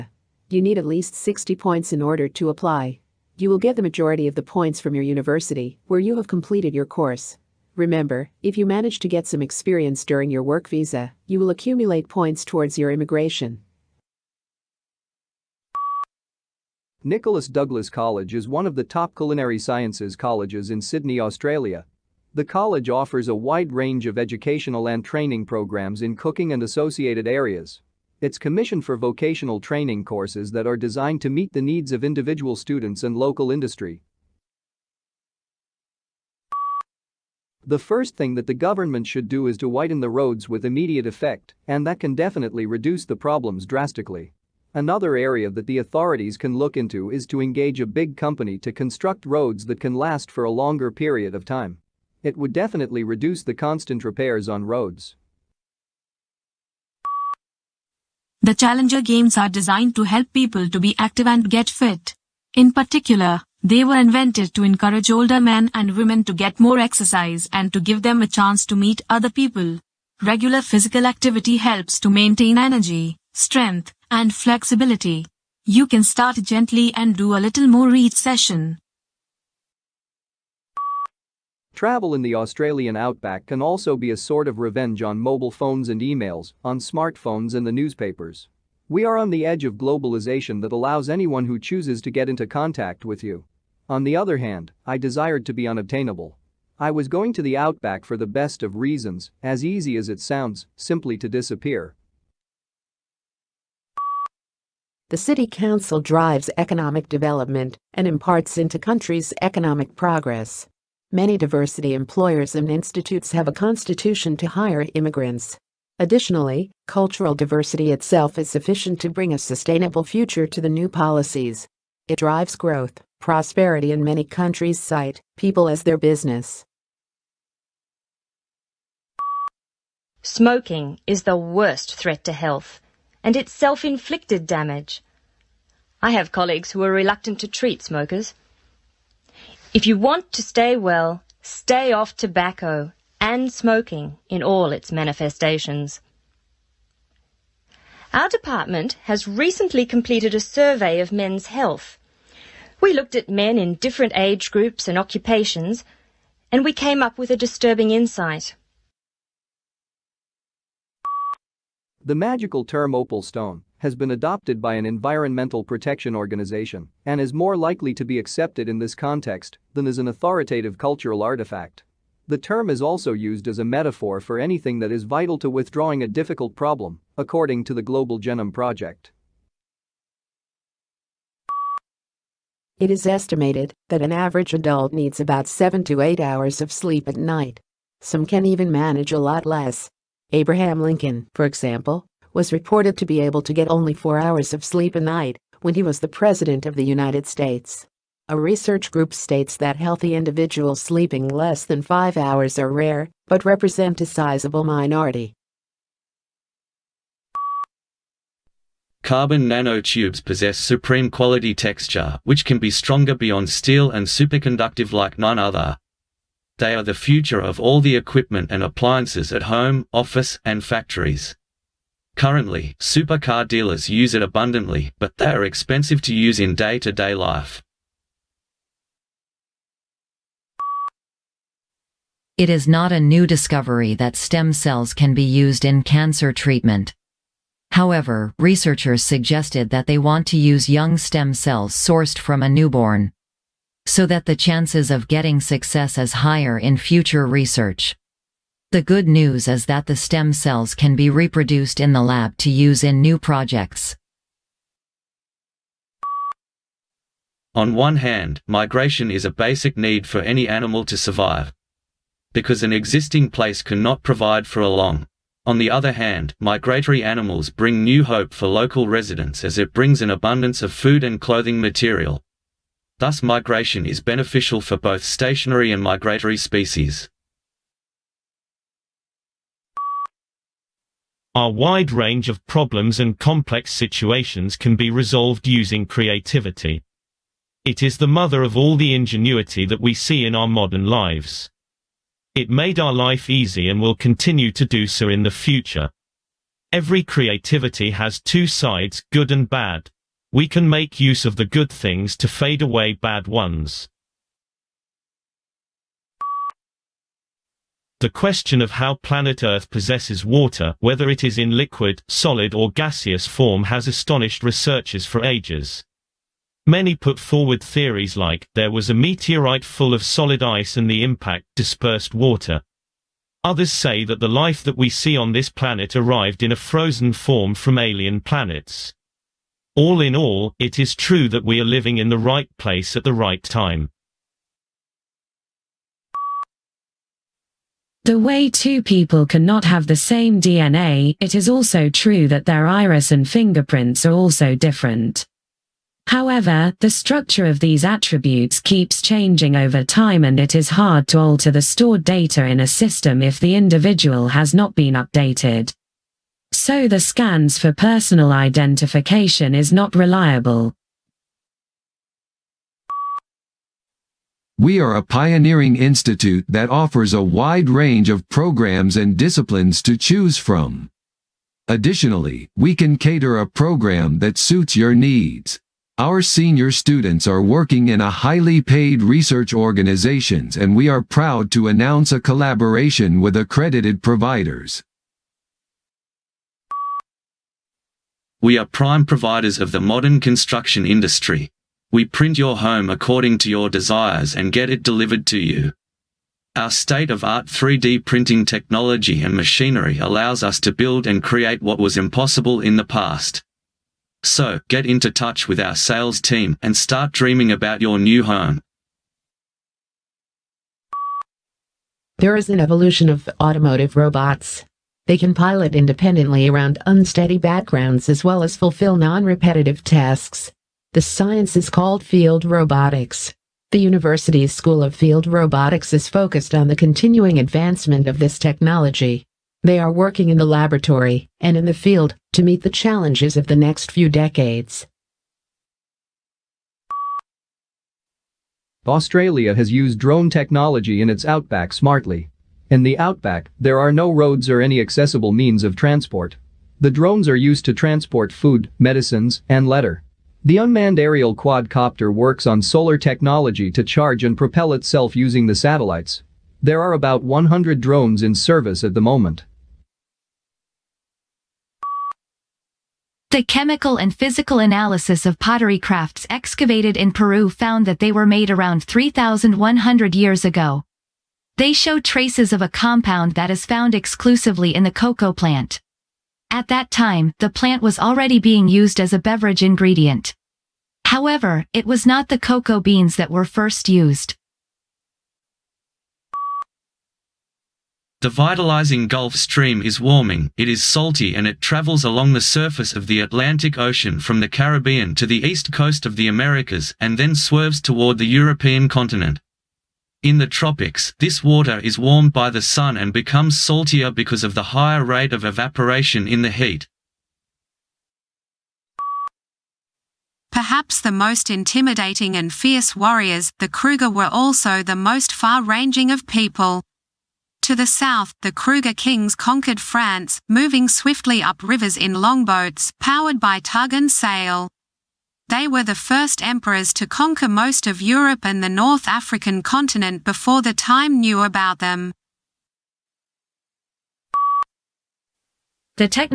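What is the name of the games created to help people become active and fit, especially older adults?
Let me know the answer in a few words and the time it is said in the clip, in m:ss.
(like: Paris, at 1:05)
Challenger games, at 0:58.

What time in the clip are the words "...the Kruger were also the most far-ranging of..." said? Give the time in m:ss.
8:33.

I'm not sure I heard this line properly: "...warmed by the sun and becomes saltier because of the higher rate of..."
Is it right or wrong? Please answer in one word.
right.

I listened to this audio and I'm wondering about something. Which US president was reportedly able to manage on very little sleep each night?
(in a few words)
Abraham Lincoln.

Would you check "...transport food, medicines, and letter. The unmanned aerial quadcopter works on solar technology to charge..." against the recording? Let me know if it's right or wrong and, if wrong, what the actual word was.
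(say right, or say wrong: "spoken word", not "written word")
right.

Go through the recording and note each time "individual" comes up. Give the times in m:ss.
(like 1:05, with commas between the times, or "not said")
0:32, 3:20, 5:53.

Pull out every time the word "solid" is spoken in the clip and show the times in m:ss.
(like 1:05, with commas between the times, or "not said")
5:12, 5:20.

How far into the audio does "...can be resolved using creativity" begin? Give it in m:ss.
4:44.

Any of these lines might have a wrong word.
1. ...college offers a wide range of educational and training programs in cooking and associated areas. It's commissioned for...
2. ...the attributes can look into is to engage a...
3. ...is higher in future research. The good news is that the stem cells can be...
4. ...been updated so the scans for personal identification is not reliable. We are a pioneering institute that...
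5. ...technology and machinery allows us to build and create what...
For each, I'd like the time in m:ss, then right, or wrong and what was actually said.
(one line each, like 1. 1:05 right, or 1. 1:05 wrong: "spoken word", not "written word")
1. 0:22 right
2. 0:45 wrong: "authorities", not "attributes"
3. 4:05 right
4. 5:54 right
5. 6:38 right.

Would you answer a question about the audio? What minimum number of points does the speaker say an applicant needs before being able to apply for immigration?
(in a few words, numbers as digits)
60.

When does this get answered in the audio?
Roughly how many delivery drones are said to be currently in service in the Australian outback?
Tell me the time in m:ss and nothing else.
7:36.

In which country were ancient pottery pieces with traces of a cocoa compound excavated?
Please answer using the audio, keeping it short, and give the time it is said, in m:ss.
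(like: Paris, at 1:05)
Peru, at 7:47.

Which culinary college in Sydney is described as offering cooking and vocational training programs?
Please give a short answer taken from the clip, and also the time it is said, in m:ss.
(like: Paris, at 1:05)
Nicholas Douglas College, at 0:17.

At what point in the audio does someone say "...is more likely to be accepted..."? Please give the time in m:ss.
2:47.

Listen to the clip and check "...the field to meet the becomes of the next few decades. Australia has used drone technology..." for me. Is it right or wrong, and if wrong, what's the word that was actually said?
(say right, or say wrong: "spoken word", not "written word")
wrong: "challenges", not "becomes".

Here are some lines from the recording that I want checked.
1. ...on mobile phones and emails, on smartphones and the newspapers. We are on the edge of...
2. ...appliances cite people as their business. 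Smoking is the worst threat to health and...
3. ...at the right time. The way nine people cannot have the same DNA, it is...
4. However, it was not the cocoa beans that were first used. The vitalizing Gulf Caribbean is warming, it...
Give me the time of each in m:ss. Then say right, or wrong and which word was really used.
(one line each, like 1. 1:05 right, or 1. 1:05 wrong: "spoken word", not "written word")
1. 1:25 right
2. 2:04 wrong: "countries", not "appliances"
3. 5:32 wrong: "two", not "nine"
4. 8:01 wrong: "Stream", not "Caribbean".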